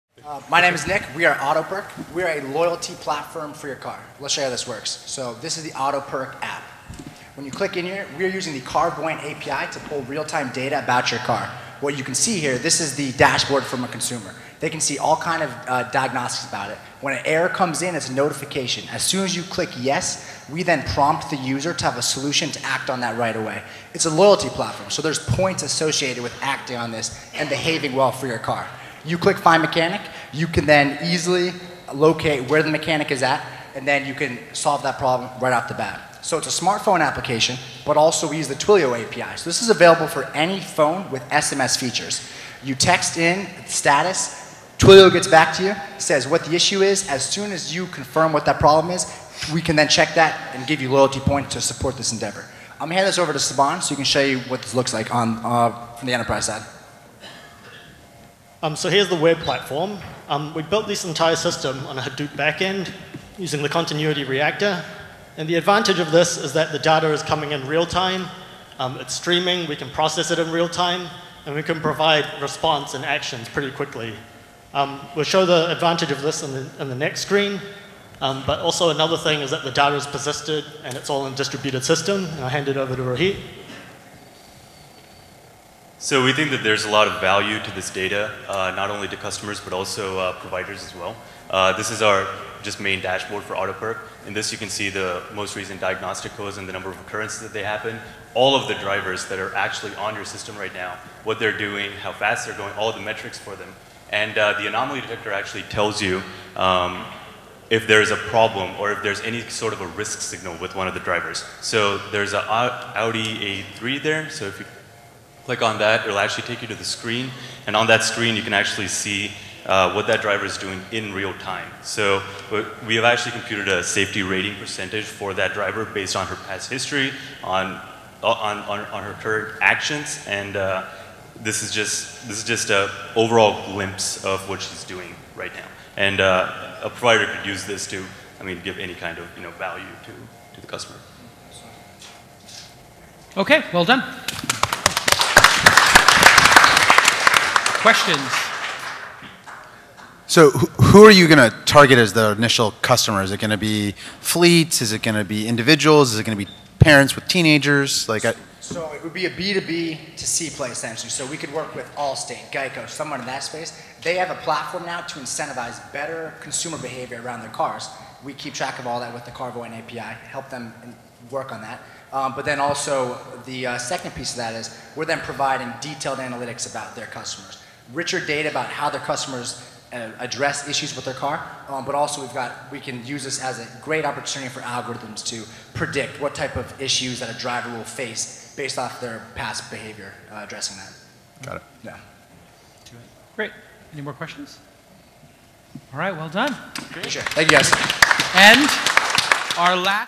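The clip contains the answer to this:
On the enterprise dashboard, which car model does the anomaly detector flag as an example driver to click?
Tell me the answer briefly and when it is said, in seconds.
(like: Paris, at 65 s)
Audi A3, at 112 s.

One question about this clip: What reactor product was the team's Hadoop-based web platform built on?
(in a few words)
Continuuity reactor.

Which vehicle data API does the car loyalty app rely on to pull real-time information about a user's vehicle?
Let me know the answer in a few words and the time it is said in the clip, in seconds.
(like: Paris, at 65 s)
Carvoyant, at 8 s.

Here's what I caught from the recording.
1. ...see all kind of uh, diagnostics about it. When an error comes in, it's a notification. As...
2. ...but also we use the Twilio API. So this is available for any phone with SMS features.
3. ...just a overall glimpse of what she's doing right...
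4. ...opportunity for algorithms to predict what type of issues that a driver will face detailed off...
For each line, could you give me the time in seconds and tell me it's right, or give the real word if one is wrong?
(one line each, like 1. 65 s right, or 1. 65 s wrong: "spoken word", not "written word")
1. 14 s right
2. 37 s right
3. 132 s right
4. 184 s wrong: "based", not "detailed".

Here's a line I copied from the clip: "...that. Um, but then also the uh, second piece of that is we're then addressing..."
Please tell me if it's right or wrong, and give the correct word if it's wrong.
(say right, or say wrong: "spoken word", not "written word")
wrong: "providing", not "addressing".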